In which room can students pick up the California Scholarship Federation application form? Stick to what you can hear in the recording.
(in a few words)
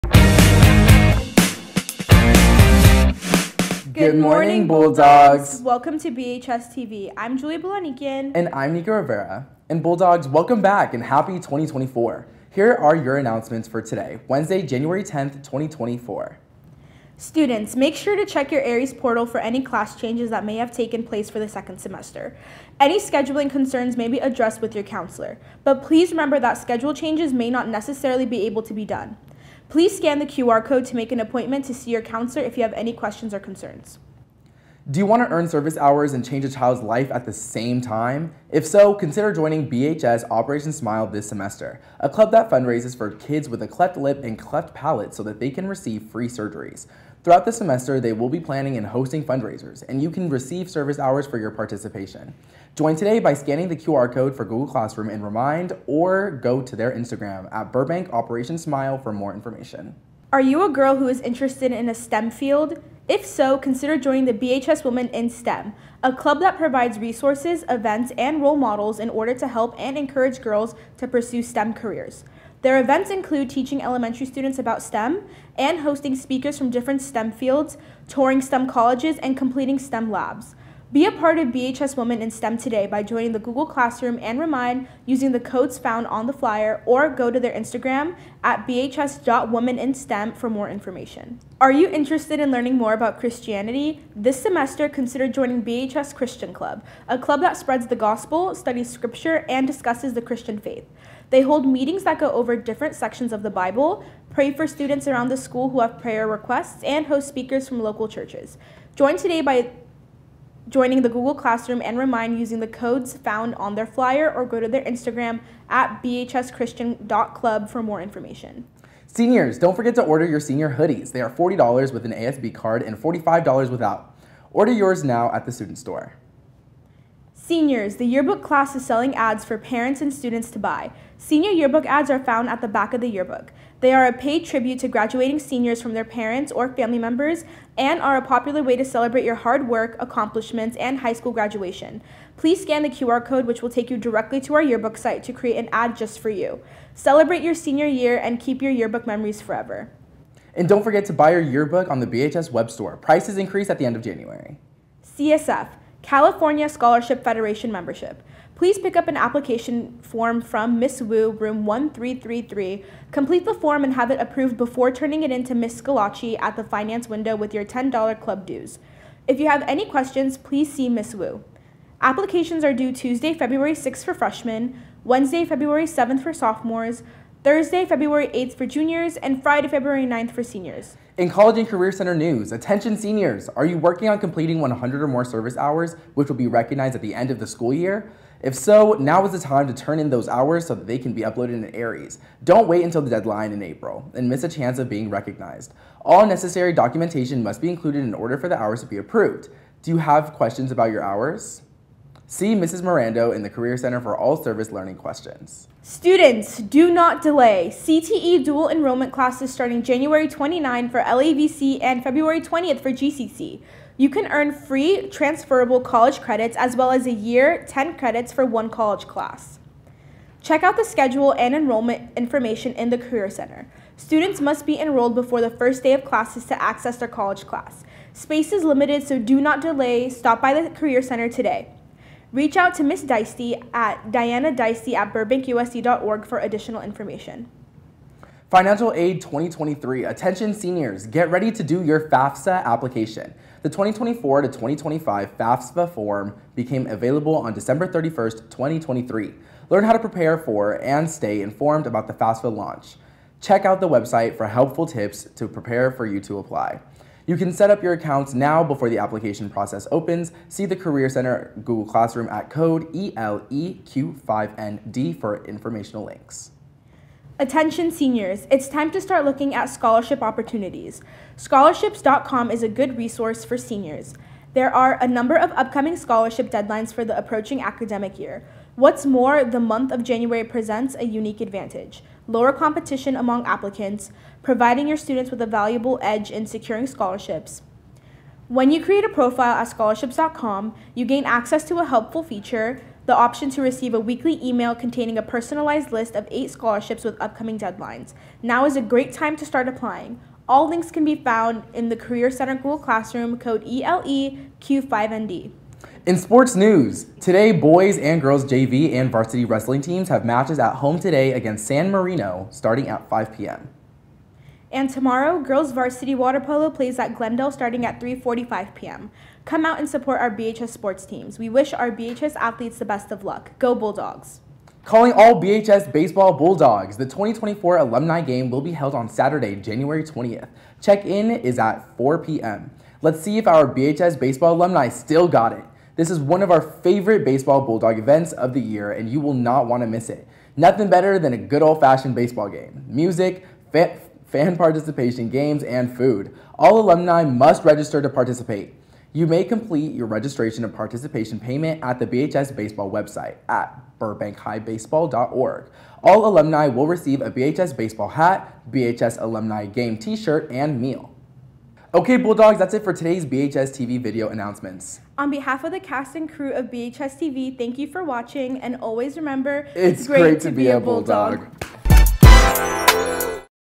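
1333.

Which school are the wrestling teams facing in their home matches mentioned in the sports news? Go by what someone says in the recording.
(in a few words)
San Marino.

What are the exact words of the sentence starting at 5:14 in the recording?
And tomorrow, girls varsity water polo plays at Glendale starting at 3:45 p.m.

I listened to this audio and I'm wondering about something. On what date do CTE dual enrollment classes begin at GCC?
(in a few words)
February 20th.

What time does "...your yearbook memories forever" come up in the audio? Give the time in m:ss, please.
2:28.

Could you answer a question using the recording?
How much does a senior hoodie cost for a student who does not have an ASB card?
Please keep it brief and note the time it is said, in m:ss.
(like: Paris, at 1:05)
$45, at 2:02.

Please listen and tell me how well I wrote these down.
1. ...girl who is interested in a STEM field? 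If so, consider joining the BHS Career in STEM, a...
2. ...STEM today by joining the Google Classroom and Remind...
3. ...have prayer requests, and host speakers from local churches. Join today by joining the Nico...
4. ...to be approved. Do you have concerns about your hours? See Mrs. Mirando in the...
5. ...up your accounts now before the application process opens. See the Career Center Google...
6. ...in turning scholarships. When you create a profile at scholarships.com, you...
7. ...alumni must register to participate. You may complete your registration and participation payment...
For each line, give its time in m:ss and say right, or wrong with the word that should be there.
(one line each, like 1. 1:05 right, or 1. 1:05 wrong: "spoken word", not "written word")
1. 1:00 wrong: "Women", not "Career"
2. 1:22 right
3. 1:45 wrong: "Google", not "Nico"
4. 3:18 wrong: "questions", not "concerns"
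5. 4:17 right
6. 4:46 wrong: "securing", not "turning"
7. 5:46 right.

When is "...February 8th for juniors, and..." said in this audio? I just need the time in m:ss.
2:57.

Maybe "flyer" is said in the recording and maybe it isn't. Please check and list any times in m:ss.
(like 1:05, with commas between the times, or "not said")
1:26, 1:53.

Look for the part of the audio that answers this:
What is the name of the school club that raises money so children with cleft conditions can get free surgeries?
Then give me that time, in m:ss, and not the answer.
0:39.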